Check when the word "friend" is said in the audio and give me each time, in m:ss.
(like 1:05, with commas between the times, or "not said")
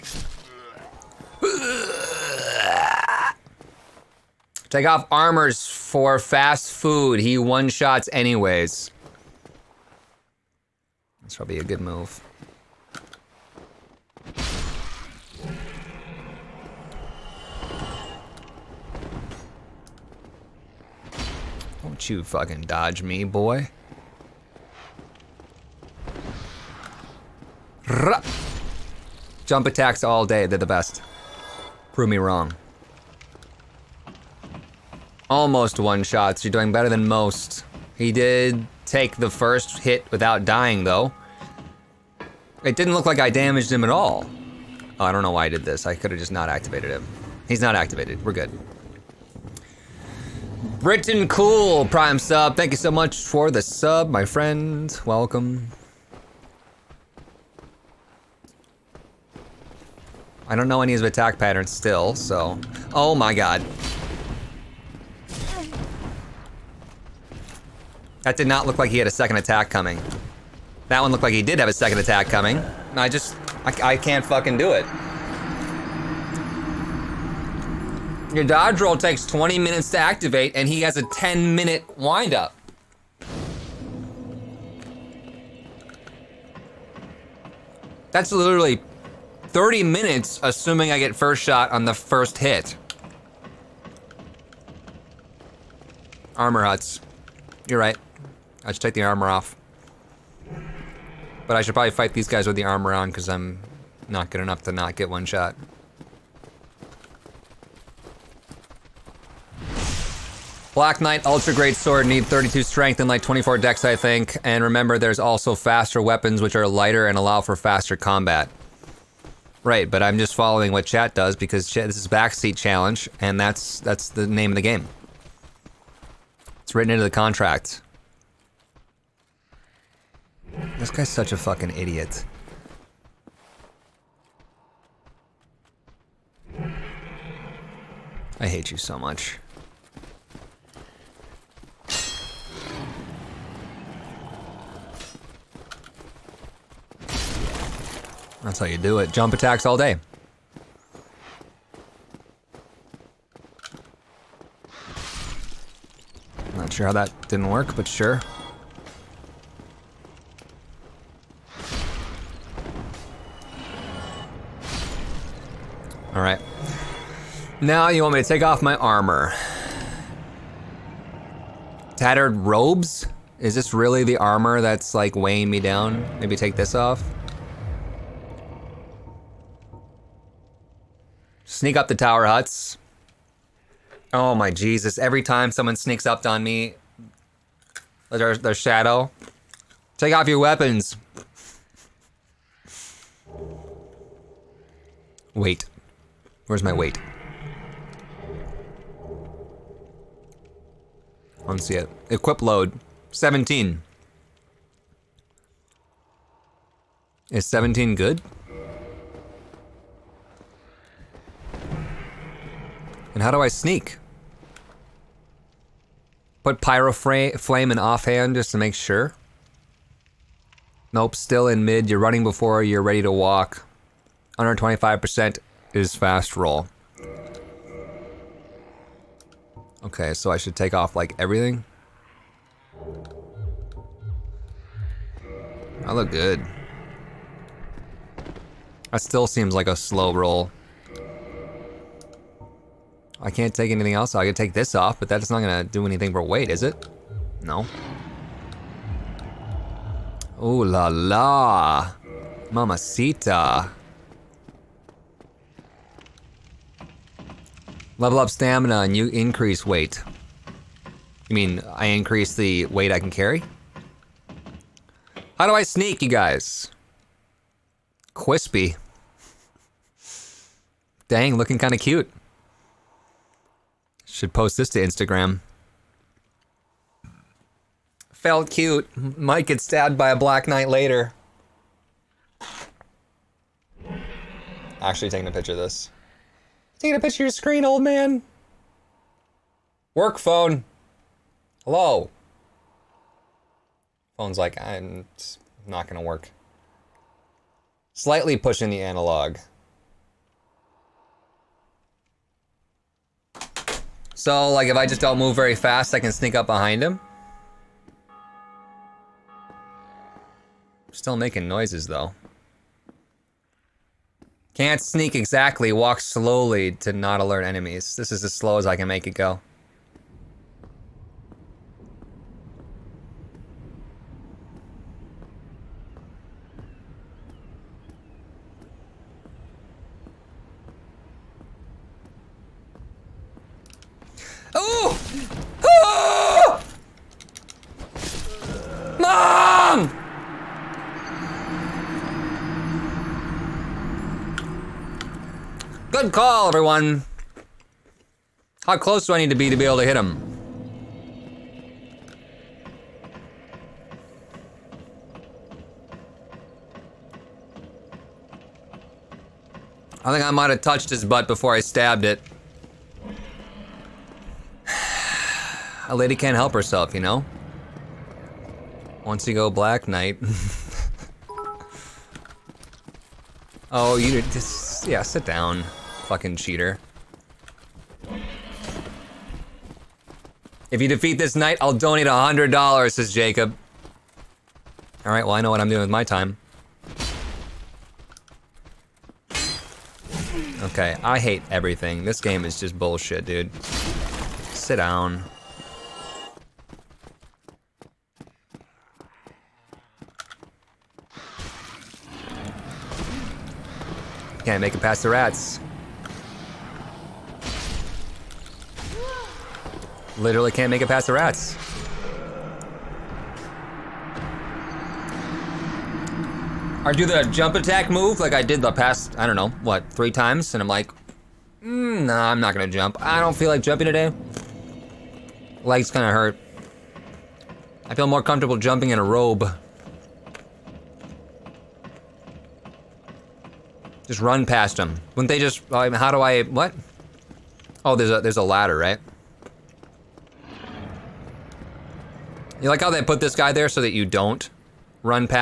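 0:54.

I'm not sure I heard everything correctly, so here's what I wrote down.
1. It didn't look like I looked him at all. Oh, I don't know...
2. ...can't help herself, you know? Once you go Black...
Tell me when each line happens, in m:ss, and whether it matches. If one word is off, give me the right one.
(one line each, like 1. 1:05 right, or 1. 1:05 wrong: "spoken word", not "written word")
1. 0:42 wrong: "damaged", not "looked"
2. 6:06 right.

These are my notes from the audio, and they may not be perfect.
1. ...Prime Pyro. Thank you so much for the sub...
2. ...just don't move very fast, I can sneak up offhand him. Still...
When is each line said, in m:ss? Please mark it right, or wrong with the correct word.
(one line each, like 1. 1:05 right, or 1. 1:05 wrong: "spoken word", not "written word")
1. 0:51 wrong: "Sub", not "Pyro"
2. 5:04 wrong: "behind", not "offhand".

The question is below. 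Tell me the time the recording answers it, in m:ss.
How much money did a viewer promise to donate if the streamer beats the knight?
6:22.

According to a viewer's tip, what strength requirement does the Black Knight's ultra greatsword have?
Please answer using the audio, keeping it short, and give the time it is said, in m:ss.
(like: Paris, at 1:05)
32, at 1:52.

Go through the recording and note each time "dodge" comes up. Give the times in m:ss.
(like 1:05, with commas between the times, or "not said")
0:22, 1:18.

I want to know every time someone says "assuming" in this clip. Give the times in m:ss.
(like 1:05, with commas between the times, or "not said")
1:30.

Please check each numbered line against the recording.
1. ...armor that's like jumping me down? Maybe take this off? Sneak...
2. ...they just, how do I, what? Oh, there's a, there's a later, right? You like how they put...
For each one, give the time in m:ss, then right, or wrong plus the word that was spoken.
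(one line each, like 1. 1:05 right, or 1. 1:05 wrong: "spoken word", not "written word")
1. 2:54 wrong: "weighing", not "jumping"
2. 7:15 wrong: "ladder", not "later".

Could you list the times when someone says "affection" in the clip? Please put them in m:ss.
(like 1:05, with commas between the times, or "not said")
not said.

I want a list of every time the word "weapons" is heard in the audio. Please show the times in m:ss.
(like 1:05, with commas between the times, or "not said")
1:56, 3:10.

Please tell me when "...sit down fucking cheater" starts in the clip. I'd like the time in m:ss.
6:15.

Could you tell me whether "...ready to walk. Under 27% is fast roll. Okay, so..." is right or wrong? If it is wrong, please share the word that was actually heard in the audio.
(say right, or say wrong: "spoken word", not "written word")
wrong: "25", not "27".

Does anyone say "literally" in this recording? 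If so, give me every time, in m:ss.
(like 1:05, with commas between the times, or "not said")
1:28, 6:50.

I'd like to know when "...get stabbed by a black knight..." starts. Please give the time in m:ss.
4:39.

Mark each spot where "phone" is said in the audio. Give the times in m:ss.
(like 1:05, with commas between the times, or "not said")
4:50, 4:54.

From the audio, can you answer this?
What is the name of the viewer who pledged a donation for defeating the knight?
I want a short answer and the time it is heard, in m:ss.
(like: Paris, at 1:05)
Jacob, at 6:23.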